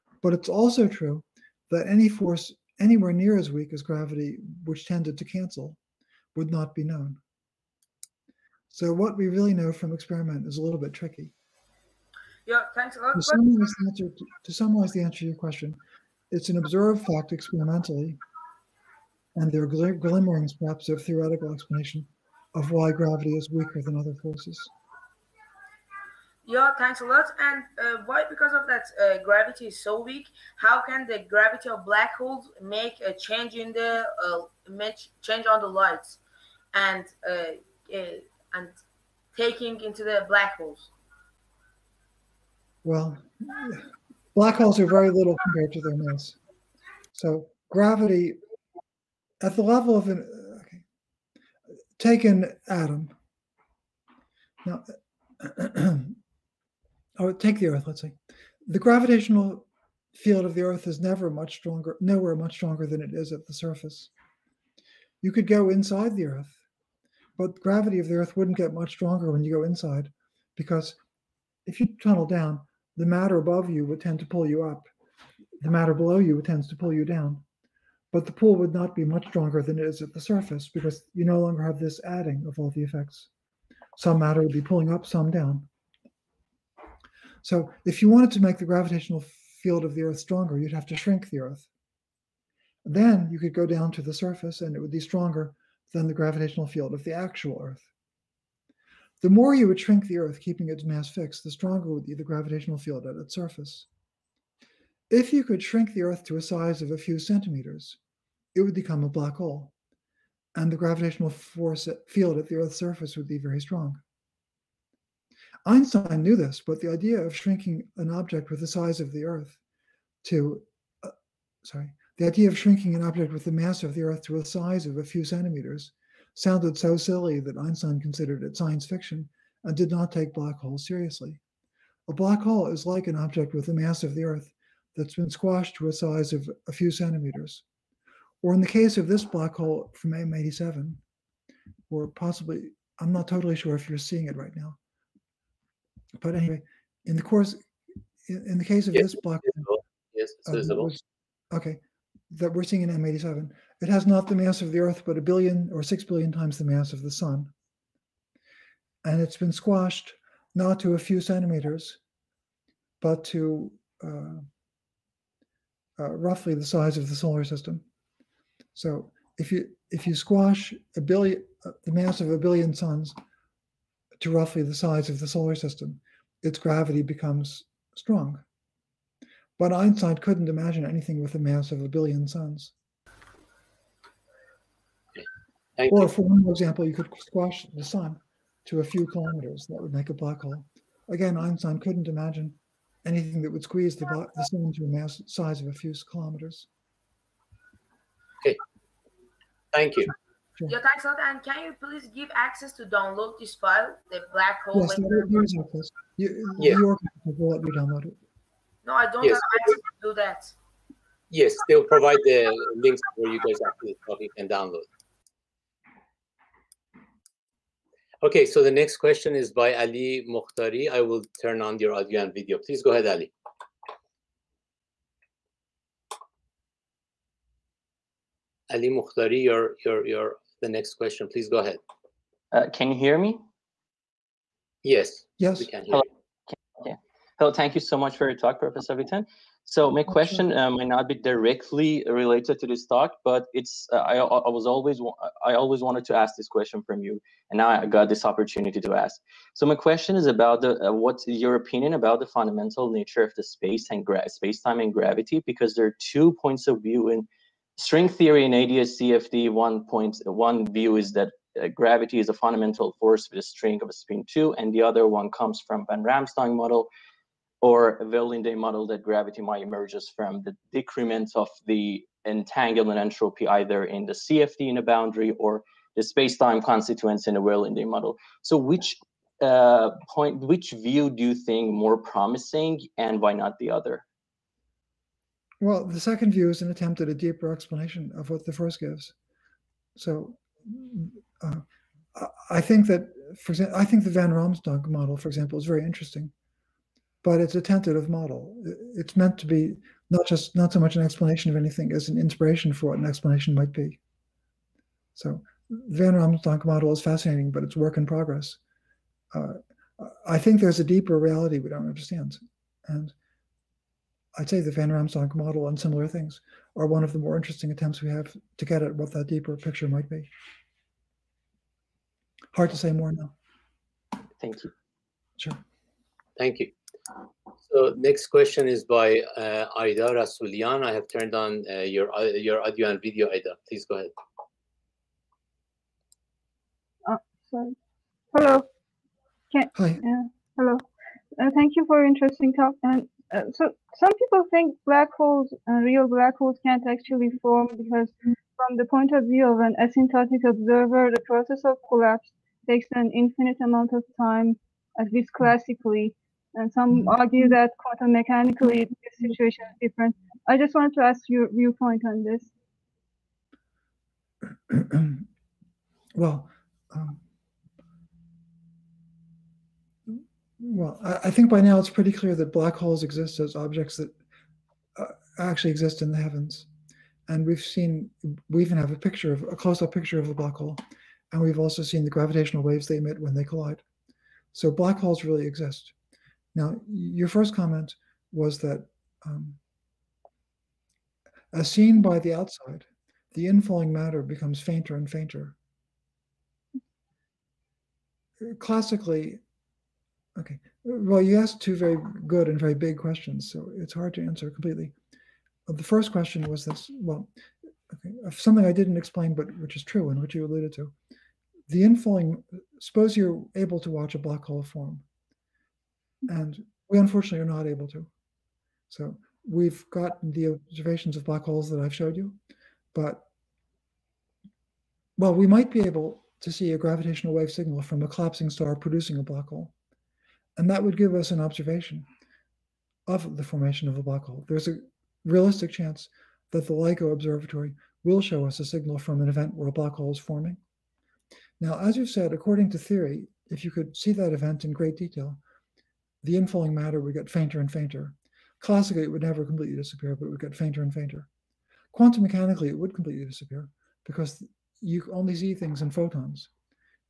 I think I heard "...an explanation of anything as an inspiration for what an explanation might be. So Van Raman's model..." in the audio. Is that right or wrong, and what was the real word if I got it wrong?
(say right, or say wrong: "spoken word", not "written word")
right.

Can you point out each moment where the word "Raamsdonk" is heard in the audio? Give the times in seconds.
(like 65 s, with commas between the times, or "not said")
266 s, 294 s, 314 s.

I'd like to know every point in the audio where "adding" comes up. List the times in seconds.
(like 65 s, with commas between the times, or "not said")
82 s.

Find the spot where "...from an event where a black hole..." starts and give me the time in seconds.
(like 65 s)
438 s.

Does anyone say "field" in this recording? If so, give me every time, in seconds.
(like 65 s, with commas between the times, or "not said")
60 s, 89 s, 96 s, 102 s, 112 s.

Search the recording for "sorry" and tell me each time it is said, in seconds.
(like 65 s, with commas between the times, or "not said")
121 s, 337 s.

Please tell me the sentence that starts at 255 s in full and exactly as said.
Because there are two points of view in string theory and AdS-CFT.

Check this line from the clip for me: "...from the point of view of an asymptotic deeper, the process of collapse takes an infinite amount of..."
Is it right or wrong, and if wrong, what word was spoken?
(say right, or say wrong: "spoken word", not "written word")
wrong: "observer", not "deeper".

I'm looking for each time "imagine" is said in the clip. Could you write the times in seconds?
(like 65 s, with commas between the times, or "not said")
180 s, 192 s.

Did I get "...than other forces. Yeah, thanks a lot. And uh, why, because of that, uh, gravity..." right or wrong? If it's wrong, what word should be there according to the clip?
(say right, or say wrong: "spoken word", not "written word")
right.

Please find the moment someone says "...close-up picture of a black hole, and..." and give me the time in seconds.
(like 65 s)
379 s.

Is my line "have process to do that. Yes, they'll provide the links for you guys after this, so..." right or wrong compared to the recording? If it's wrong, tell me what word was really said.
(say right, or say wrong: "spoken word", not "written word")
wrong: "access", not "process".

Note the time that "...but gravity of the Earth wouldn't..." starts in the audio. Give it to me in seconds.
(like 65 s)
67 s.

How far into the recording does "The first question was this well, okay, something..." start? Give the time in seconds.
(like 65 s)
405 s.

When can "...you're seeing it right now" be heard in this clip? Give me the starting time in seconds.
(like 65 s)
143 s.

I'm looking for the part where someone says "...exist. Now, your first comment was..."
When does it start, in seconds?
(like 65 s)
385 s.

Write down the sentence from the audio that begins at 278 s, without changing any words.
So which uh, point, which view do you think more promising and why not the other?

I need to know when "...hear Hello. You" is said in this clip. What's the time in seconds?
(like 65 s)
235 s.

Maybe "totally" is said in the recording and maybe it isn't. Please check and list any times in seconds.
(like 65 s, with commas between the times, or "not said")
143 s.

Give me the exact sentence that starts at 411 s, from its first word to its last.
The inflowing, suppose you're able to watch a black hole form and we unfortunately are not able to.